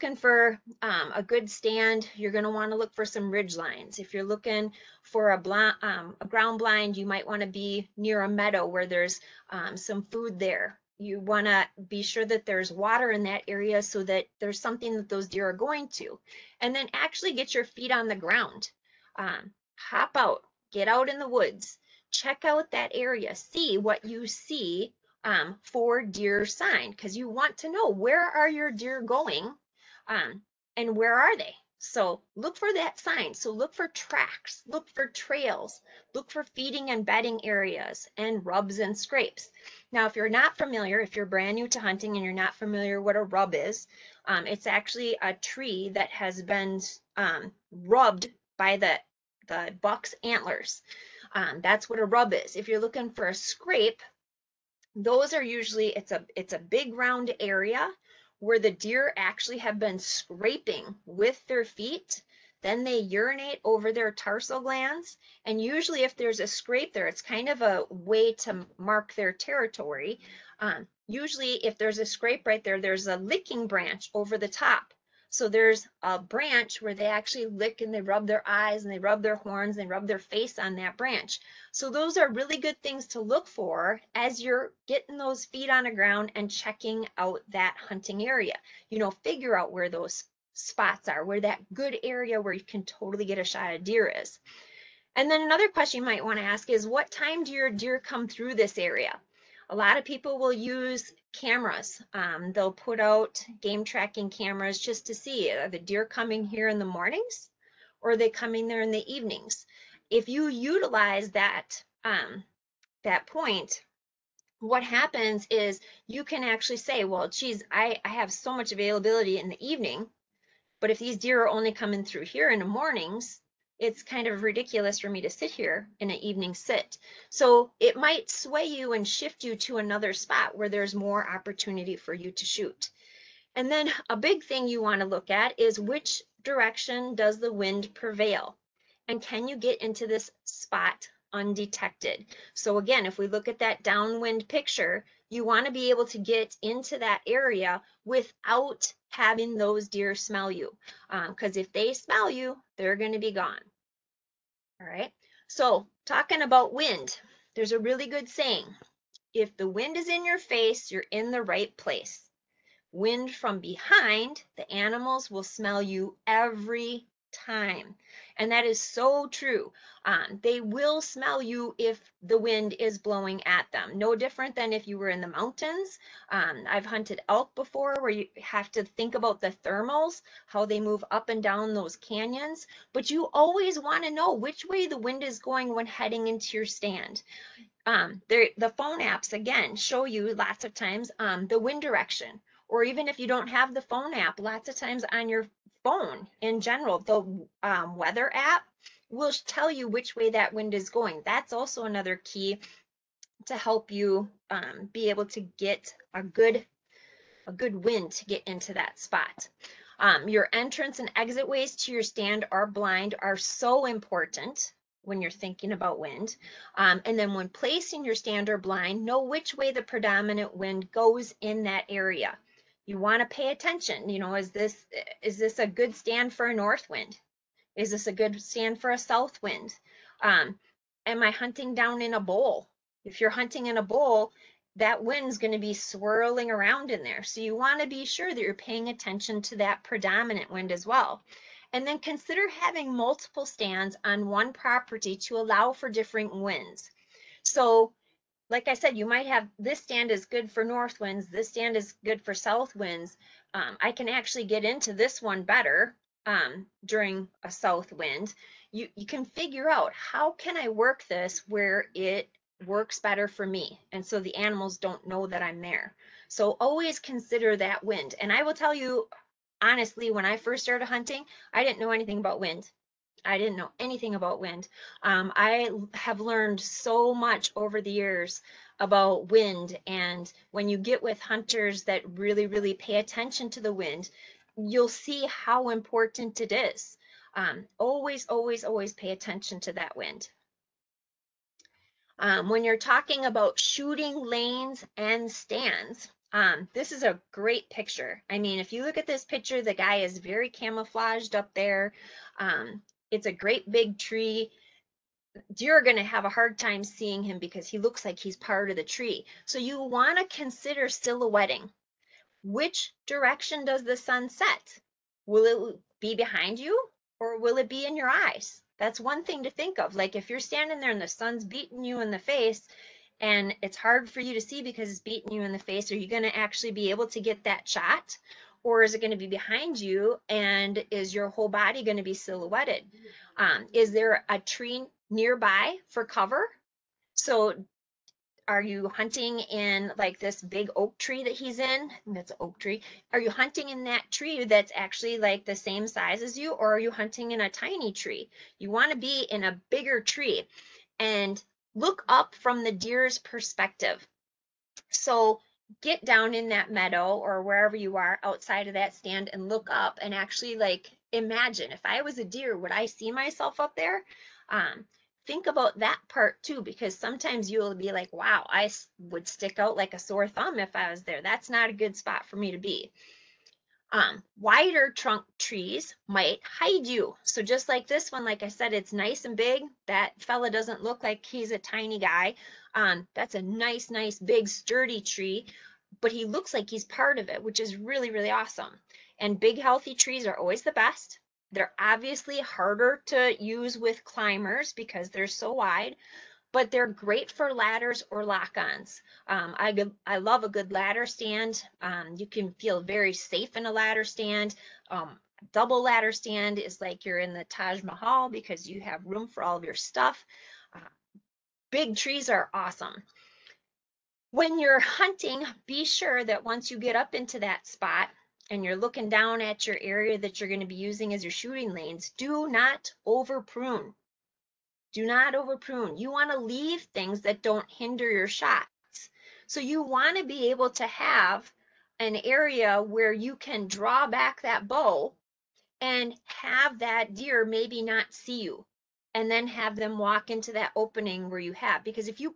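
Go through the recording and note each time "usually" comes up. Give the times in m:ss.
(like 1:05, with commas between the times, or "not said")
0:55, 1:05, 1:11.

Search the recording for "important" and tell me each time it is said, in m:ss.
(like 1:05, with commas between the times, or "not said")
3:33, 4:45.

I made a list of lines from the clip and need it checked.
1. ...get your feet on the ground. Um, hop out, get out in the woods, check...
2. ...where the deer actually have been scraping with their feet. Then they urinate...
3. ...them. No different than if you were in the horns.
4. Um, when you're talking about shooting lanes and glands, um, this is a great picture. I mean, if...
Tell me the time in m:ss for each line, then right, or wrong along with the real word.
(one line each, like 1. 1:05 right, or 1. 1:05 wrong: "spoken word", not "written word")
1. 0:17 right
2. 0:58 right
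3. 2:53 wrong: "mountains", not "horns"
4. 4:52 wrong: "stands", not "glands".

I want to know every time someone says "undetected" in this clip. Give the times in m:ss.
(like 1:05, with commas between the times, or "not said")
2:21.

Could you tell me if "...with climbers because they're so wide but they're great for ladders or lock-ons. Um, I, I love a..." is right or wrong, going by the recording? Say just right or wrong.
right.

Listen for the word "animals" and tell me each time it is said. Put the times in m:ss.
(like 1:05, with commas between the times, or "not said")
2:44, 4:24.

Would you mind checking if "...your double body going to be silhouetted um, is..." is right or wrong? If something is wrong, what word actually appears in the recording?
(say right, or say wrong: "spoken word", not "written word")
wrong: "whole", not "double".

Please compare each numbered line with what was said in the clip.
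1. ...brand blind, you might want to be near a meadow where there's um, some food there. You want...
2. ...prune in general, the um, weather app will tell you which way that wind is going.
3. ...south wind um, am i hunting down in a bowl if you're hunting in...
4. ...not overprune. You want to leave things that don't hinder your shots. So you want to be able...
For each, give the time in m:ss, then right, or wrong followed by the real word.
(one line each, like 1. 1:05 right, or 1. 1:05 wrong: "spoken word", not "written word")
1. 0:06 wrong: "ground", not "brand"
2. 3:15 wrong: "phone", not "prune"
3. 3:48 right
4. 7:05 right.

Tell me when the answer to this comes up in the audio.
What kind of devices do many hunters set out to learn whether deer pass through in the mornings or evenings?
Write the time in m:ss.
1:43.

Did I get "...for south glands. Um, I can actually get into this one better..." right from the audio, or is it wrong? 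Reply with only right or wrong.
wrong.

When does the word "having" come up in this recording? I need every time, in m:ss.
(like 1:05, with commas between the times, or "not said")
2:29, 4:02.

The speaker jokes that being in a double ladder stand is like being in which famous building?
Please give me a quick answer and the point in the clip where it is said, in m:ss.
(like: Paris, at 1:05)
the Taj Mahal, at 6:47.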